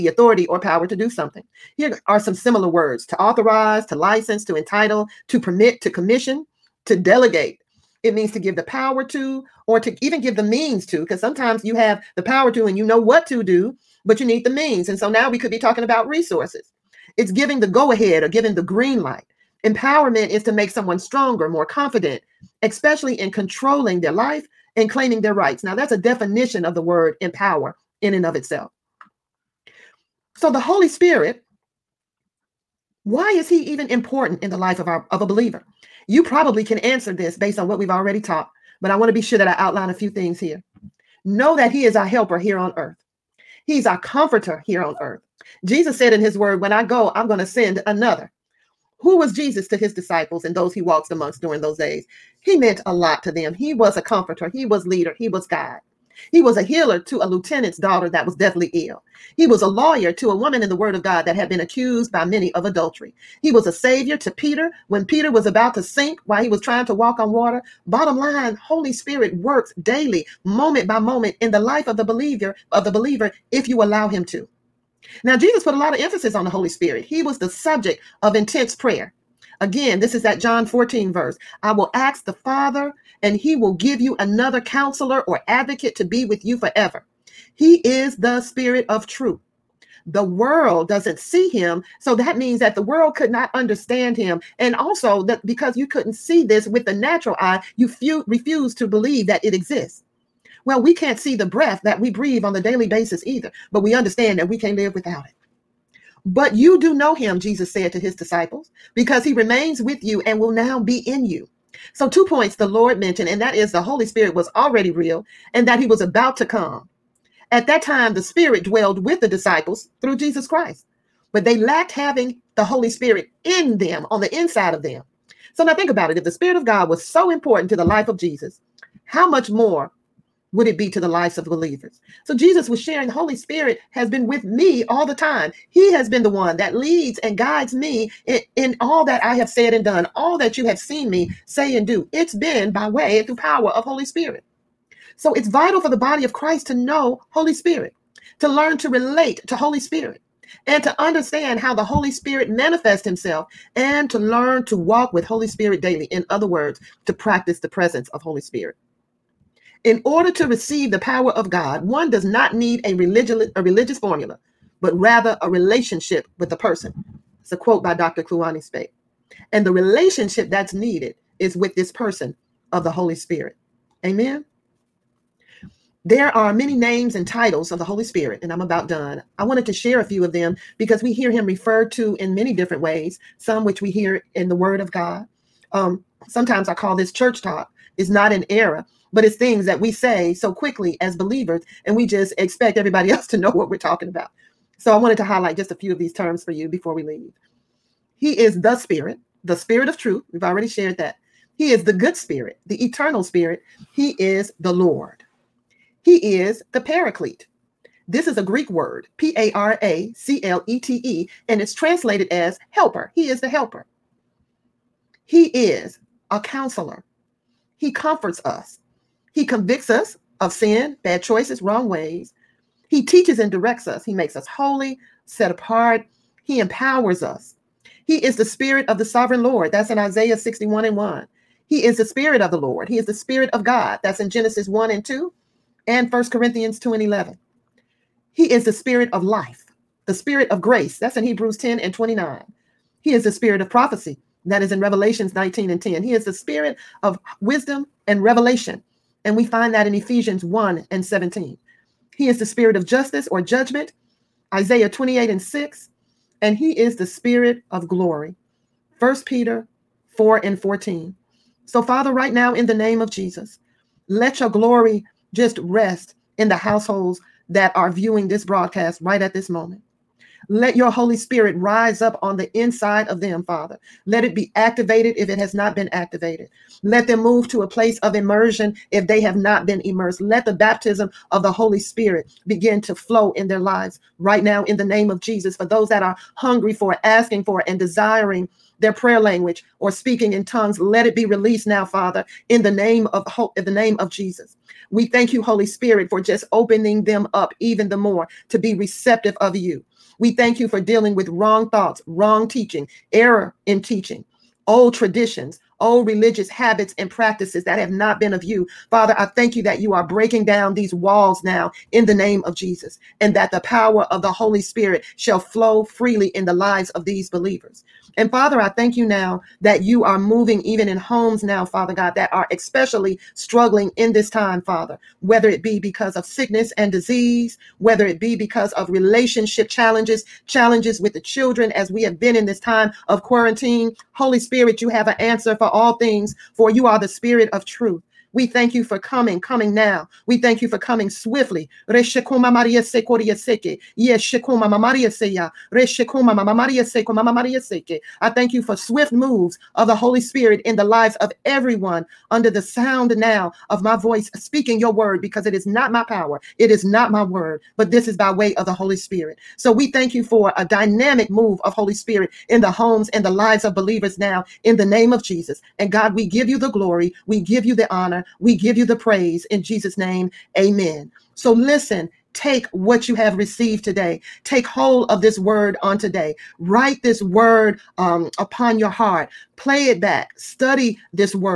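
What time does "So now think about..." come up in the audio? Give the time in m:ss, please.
2:05.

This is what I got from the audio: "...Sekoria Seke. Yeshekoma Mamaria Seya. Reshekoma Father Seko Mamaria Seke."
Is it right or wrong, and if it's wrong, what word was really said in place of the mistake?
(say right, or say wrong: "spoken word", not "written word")
wrong: "Mamaria", not "Father".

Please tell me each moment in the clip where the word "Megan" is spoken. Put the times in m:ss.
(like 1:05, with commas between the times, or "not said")
not said.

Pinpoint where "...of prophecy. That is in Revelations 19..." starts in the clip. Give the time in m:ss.
4:03.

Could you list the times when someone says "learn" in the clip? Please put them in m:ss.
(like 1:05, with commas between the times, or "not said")
2:28, 2:34.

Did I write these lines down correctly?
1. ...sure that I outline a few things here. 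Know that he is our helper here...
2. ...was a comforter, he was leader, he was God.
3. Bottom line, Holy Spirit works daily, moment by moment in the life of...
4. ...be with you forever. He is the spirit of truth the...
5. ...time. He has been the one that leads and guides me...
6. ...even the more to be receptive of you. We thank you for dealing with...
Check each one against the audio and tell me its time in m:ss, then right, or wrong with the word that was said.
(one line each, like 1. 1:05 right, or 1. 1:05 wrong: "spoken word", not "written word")
1. 0:39 right
2. 0:53 right
3. 1:07 right
4. 1:26 right
5. 2:15 right
6. 4:57 right.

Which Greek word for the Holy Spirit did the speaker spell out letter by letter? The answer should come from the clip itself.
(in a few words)
Paraclete.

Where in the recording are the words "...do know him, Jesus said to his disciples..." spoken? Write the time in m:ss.
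1:46.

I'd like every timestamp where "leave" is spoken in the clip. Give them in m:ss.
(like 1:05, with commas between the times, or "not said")
3:17.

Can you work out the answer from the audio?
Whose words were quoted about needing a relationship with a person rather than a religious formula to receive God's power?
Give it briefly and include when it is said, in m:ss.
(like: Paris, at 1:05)
Dr. Kluane Spake, at 2:47.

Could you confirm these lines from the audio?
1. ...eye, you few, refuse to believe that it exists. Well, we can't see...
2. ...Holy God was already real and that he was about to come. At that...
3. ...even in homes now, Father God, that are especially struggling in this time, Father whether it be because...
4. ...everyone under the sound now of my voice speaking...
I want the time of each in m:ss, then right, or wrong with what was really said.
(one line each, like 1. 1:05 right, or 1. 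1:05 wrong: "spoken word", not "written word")
1. 1:37 right
2. 1:53 wrong: "Spirit", not "God"
3. 5:20 right
4. 5:51 right.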